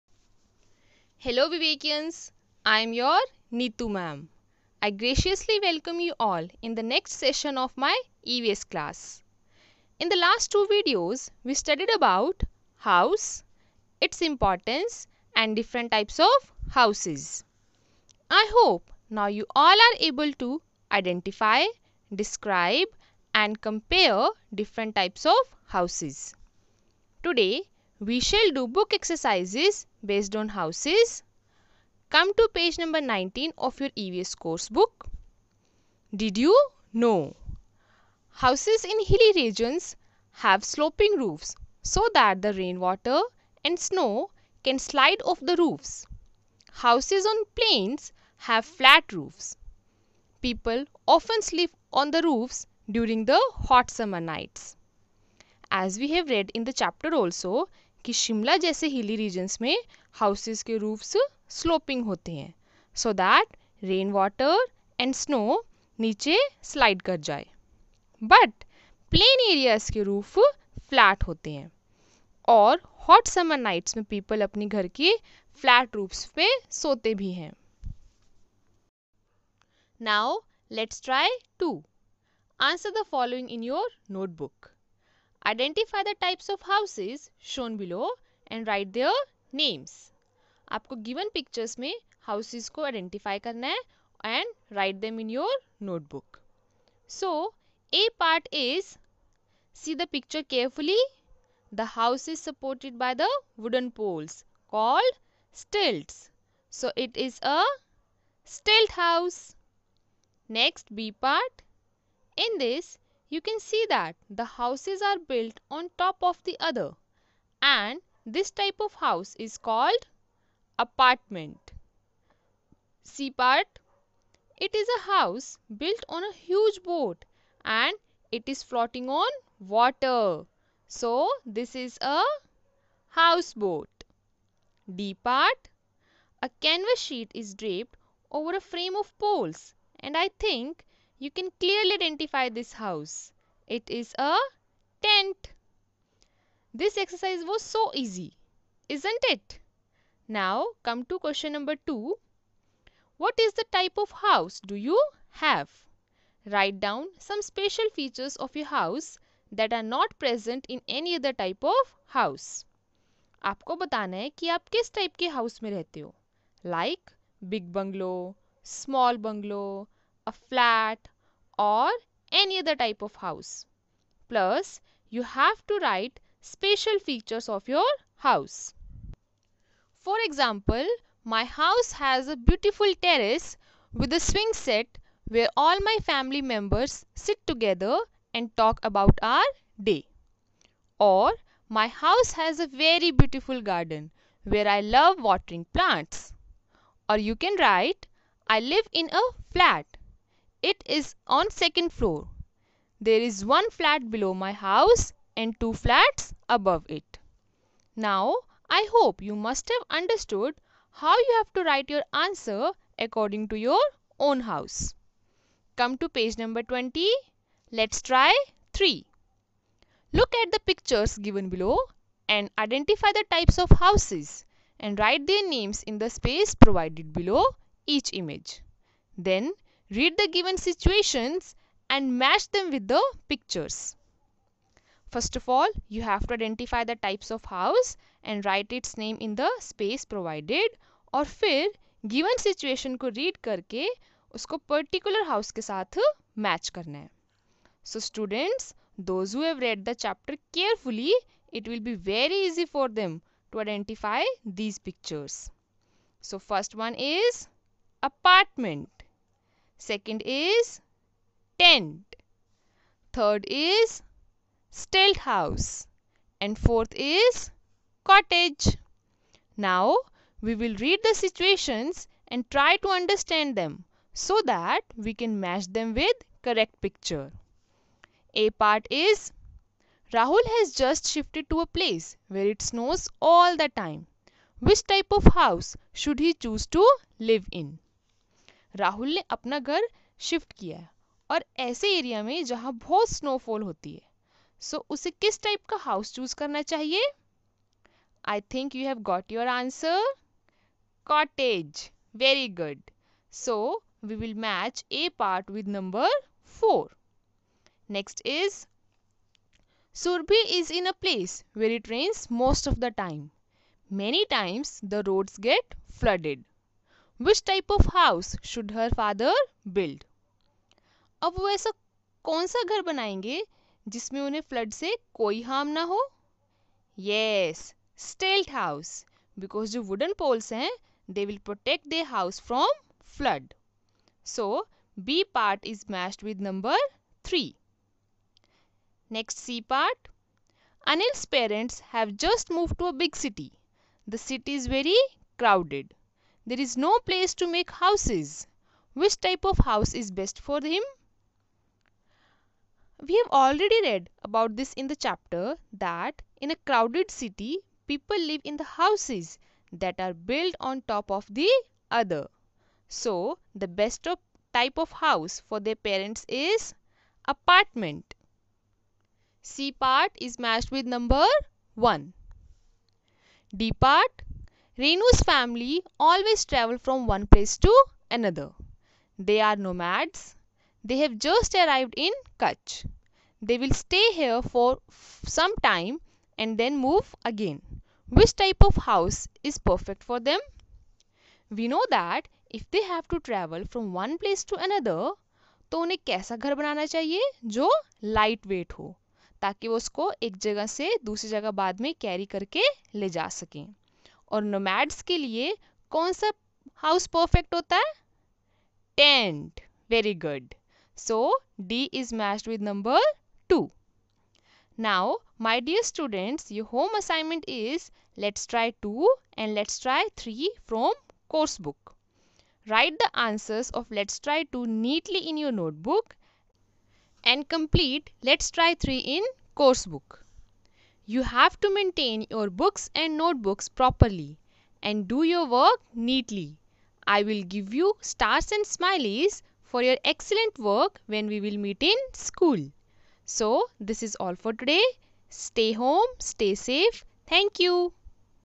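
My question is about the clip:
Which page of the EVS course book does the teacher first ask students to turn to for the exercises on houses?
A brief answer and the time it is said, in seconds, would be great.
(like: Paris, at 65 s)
19, at 32 s.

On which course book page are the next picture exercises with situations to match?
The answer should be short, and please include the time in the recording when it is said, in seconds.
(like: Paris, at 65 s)
20, at 216 s.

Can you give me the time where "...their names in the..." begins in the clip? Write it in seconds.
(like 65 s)
225 s.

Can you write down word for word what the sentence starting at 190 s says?
Or my house has a very beautiful garden where I love watering plants.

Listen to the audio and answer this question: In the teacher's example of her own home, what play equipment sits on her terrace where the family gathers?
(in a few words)
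swing set.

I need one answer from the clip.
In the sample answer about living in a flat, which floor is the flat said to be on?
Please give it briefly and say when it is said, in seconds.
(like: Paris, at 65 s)
second floor, at 201 s.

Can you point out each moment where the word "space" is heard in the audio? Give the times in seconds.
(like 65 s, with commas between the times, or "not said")
226 s, 239 s.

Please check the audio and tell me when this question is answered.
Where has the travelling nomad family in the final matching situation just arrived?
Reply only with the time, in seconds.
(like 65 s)
382 s.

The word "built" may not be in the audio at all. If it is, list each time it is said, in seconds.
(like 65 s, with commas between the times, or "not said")
115 s, 125 s, 360 s.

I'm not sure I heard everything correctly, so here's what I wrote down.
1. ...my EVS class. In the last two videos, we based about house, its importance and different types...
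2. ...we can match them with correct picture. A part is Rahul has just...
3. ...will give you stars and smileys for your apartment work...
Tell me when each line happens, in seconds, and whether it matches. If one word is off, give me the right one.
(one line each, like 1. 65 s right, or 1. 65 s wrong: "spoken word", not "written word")
1. 7 s wrong: "studied", not "based"
2. 274 s right
3. 437 s wrong: "excellent", not "apartment".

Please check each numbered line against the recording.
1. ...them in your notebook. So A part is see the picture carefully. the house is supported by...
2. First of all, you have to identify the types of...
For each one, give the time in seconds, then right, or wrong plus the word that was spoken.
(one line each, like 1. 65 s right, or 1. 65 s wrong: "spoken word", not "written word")
1. 95 s right
2. 235 s right.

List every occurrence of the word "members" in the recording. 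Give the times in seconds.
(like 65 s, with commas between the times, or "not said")
186 s.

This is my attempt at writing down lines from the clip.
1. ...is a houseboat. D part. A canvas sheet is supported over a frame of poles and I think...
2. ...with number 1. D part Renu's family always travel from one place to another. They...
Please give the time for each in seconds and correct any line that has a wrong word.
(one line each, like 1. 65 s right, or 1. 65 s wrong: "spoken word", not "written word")
1. 131 s wrong: "draped", not "supported"
2. 370 s right.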